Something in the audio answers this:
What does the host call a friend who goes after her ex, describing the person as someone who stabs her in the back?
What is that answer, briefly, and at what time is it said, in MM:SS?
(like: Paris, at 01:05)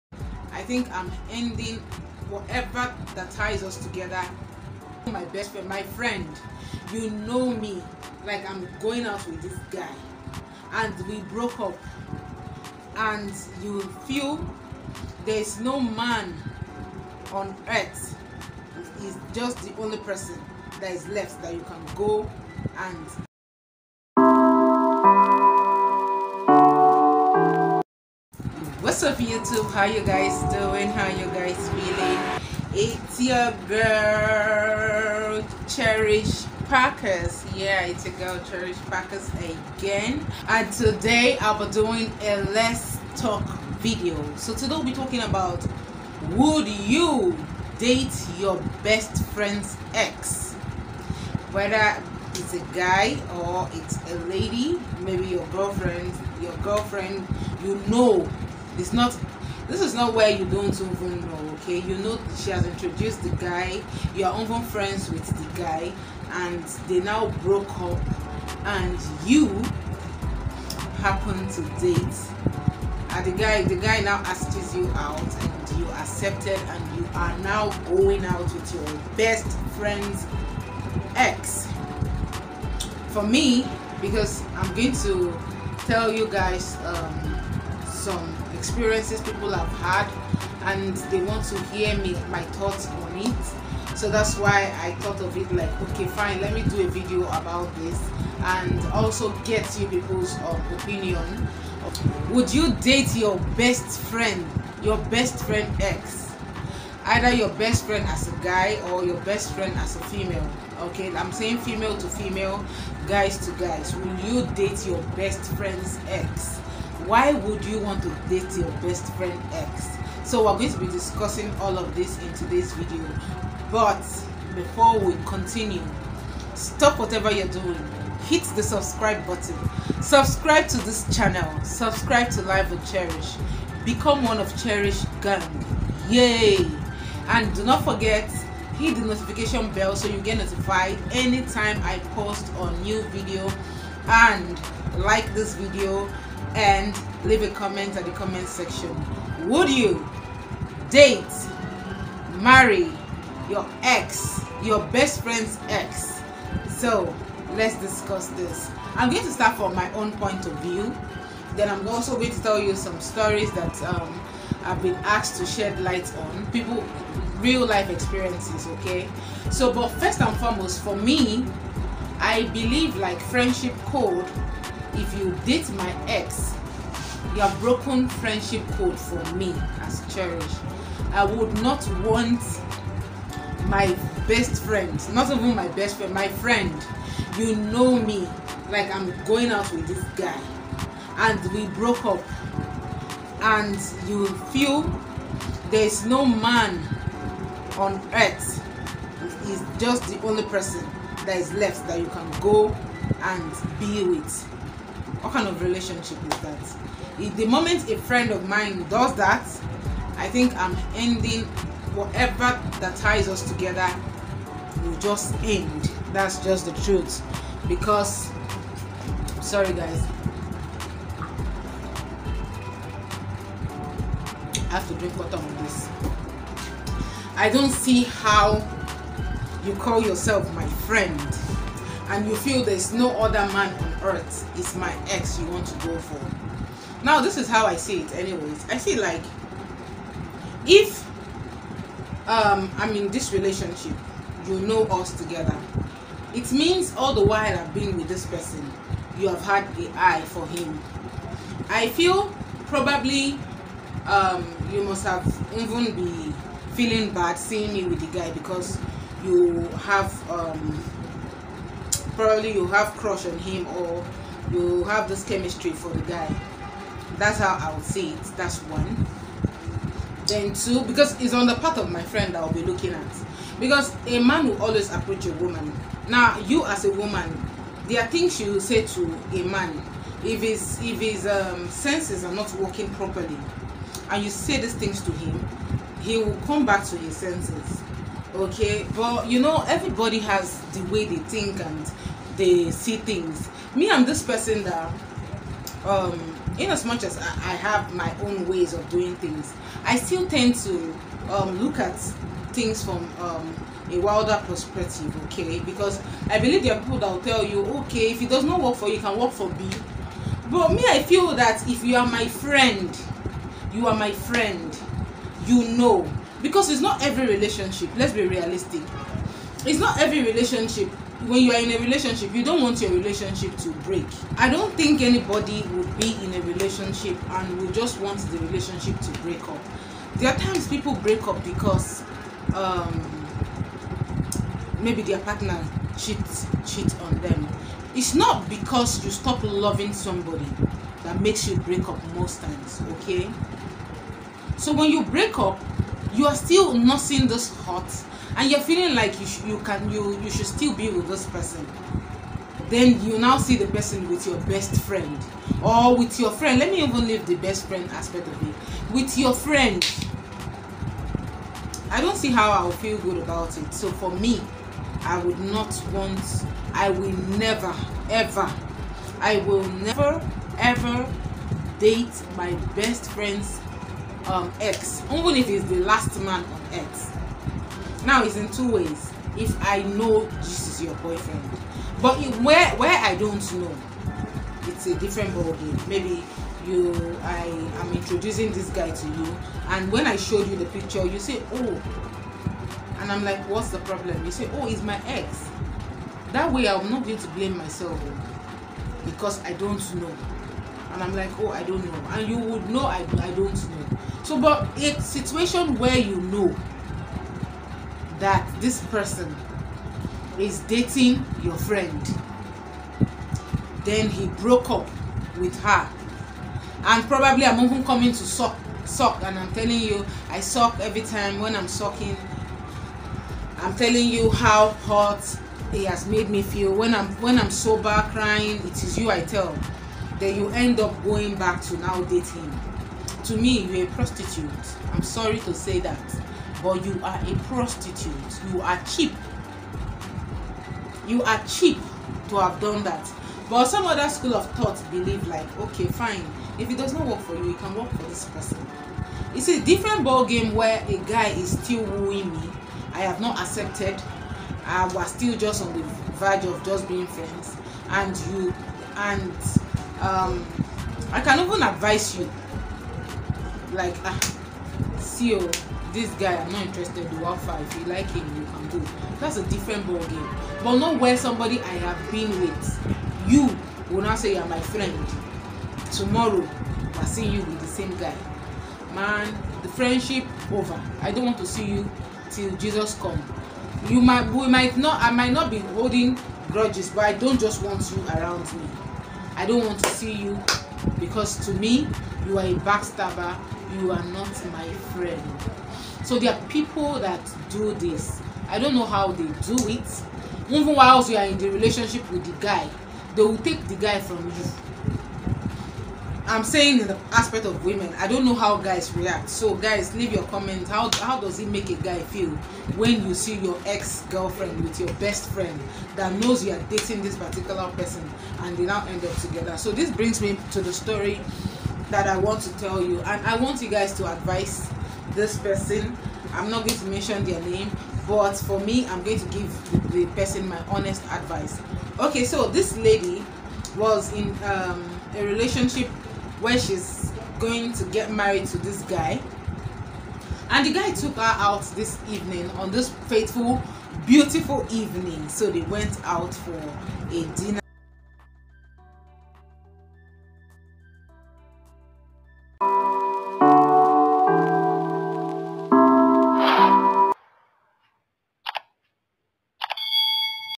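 backstabber, at 08:12.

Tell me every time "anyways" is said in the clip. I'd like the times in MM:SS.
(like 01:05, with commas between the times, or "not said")
03:58.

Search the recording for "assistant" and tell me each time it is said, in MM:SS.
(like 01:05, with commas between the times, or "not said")
not said.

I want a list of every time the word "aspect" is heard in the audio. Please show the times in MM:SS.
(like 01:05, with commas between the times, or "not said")
05:57, 08:27.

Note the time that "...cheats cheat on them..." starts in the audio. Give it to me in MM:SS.
05:35.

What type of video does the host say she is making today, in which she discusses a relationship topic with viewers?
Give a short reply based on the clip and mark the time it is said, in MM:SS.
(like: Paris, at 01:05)
let's talk video, at 00:42.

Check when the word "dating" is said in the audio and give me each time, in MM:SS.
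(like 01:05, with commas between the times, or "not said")
06:50, 07:12, 08:36.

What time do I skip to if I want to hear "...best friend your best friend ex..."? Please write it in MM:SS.
01:43.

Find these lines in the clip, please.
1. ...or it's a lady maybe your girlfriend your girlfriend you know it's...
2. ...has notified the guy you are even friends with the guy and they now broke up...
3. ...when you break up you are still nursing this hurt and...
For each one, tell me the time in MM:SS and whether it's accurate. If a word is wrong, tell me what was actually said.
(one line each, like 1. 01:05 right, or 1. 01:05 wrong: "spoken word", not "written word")
1. 00:53 right
2. 01:02 wrong: "introduced", not "notified"
3. 05:44 right.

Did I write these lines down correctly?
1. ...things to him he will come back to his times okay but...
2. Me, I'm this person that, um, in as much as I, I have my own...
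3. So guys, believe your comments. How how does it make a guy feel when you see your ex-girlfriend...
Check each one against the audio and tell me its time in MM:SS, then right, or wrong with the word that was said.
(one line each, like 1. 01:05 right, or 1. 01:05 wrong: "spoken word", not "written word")
1. 04:44 wrong: "senses", not "times"
2. 04:53 right
3. 08:29 wrong: "leave", not "believe".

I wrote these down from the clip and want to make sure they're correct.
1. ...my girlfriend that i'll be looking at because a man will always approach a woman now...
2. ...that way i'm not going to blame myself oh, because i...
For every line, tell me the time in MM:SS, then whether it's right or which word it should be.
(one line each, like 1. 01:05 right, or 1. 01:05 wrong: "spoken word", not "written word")
1. 04:31 wrong: "friend", not "girlfriend"
2. 06:36 right.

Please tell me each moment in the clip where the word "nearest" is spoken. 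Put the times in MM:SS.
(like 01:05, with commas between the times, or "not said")
not said.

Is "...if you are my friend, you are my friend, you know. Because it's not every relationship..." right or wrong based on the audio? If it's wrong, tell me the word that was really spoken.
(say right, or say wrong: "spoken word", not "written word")
right.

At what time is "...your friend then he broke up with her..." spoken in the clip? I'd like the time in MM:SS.
06:51.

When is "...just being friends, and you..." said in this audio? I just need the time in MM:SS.
07:36.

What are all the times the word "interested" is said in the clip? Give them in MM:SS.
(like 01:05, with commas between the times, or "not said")
07:46.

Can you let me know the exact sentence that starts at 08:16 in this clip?
So there are people that do this.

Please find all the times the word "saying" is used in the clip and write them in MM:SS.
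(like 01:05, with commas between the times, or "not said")
01:51, 08:26.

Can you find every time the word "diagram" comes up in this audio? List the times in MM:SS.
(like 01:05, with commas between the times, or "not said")
not said.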